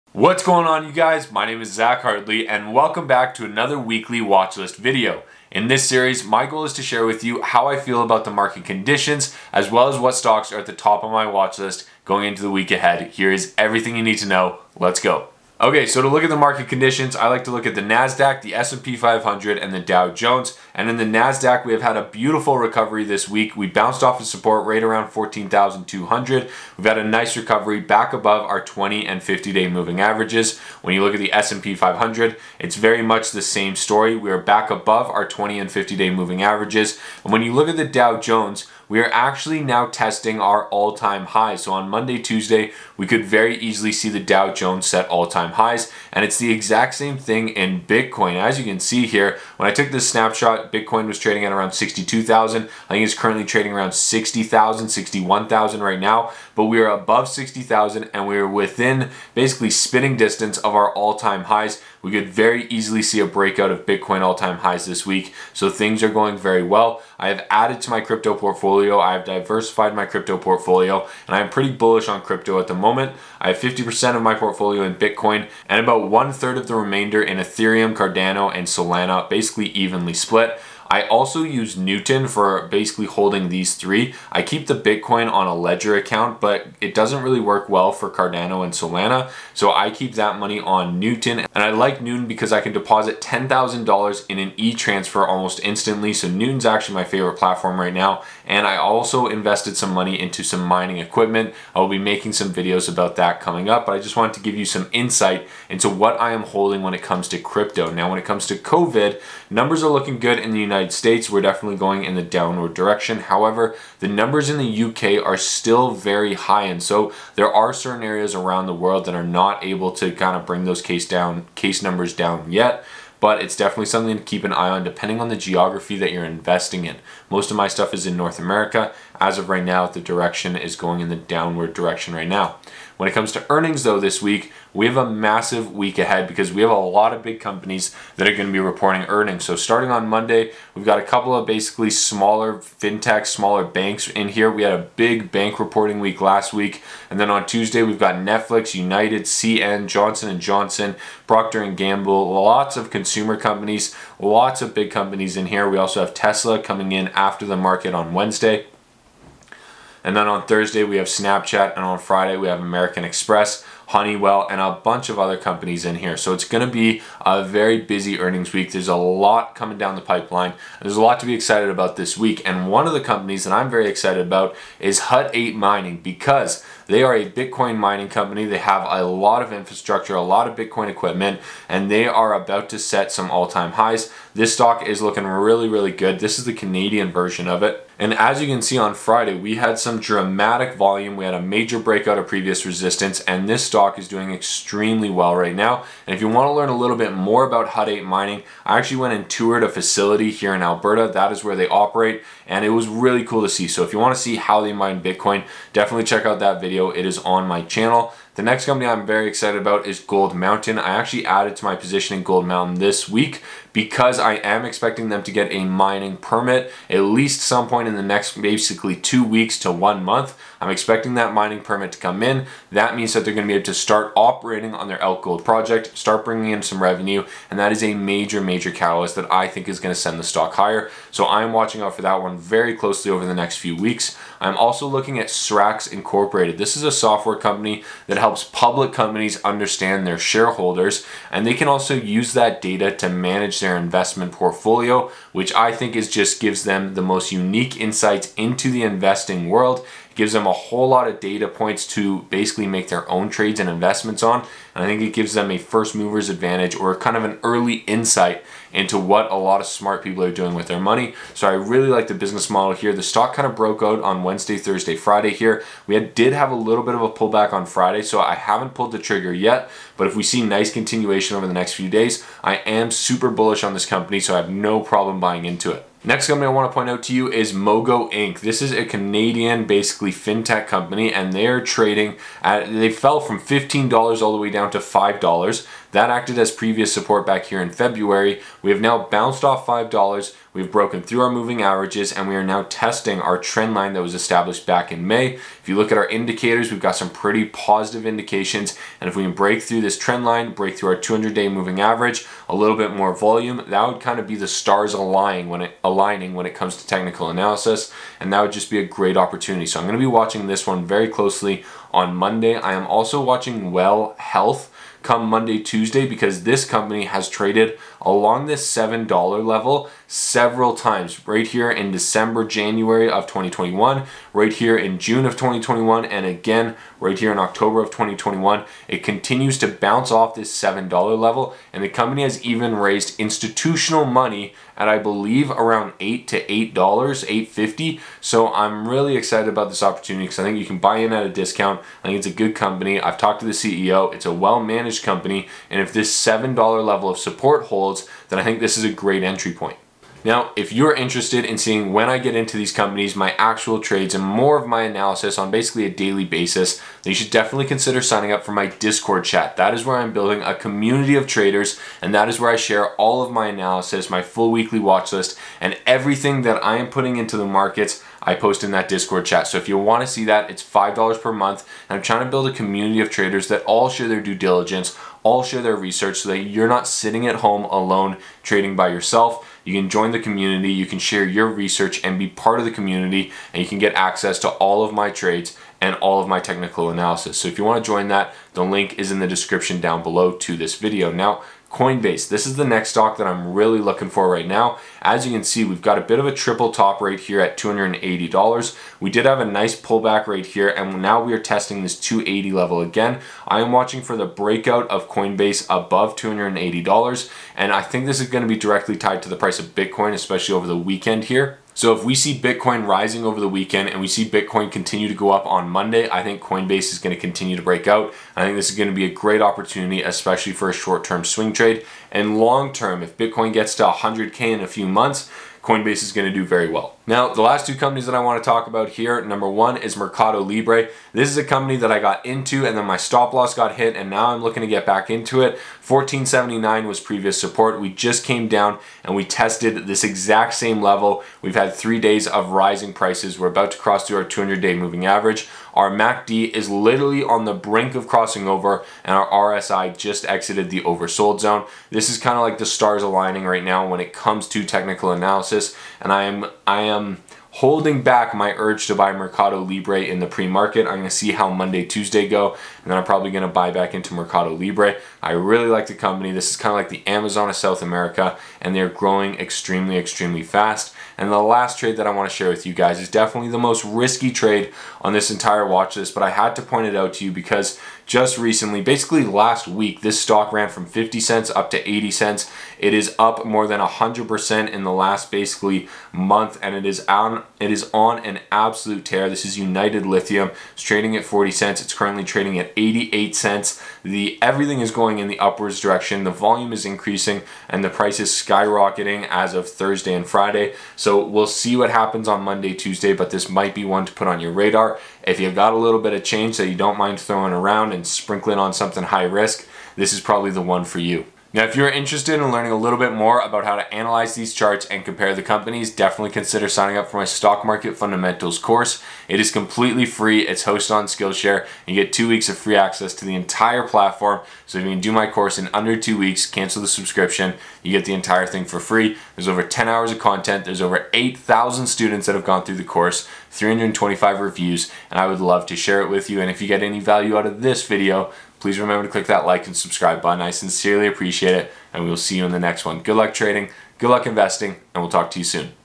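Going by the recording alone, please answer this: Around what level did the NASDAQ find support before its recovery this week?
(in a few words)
14,200.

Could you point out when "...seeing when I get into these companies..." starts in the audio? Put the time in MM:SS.
05:51.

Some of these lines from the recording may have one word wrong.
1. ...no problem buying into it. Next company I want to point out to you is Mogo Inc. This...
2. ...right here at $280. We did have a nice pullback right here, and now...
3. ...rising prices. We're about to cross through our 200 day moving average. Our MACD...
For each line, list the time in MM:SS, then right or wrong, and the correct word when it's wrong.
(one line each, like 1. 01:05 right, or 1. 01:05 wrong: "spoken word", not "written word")
1. 04:34 right
2. 06:36 right
3. 07:22 right.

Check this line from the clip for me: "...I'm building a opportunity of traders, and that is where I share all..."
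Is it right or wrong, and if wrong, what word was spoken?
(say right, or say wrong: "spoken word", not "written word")
wrong: "community", not "opportunity".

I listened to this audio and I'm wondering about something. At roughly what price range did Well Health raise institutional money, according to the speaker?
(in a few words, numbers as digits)
$8 to $8.50.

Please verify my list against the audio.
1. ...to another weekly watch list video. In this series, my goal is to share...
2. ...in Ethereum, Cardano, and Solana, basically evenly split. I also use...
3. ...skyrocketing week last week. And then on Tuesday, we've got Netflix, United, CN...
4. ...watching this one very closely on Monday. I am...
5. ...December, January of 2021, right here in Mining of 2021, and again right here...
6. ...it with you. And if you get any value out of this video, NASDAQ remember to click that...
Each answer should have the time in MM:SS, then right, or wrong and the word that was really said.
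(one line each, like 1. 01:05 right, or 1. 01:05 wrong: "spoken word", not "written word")
1. 00:03 right
2. 01:17 right
3. 02:25 wrong: "reporting", not "skyrocketing"
4. 05:10 right
5. 05:21 wrong: "June", not "Mining"
6. 08:56 wrong: "Please", not "NASDAQ".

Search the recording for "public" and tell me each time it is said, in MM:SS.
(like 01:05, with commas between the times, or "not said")
03:58.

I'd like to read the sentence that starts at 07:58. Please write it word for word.
Basically last week, this stock ran from 50 cents up to 80 cents.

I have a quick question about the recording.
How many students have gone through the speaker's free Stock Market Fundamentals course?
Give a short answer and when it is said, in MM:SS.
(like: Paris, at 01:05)
over 8,000, at 08:50.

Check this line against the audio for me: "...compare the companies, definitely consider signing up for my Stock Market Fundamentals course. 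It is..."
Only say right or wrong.
right.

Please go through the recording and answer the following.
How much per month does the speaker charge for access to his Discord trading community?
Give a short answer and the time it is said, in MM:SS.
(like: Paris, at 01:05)
$5, at 06:10.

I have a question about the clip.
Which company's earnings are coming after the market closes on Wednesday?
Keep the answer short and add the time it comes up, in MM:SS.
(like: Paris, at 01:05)
Tesla, at 02:36.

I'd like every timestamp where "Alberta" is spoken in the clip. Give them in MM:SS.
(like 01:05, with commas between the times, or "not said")
03:20.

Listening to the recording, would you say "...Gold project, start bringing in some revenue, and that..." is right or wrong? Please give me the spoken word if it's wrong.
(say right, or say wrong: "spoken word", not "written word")
right.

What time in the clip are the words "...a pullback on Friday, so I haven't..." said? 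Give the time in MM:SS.
04:27.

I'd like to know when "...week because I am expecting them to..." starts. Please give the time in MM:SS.
03:33.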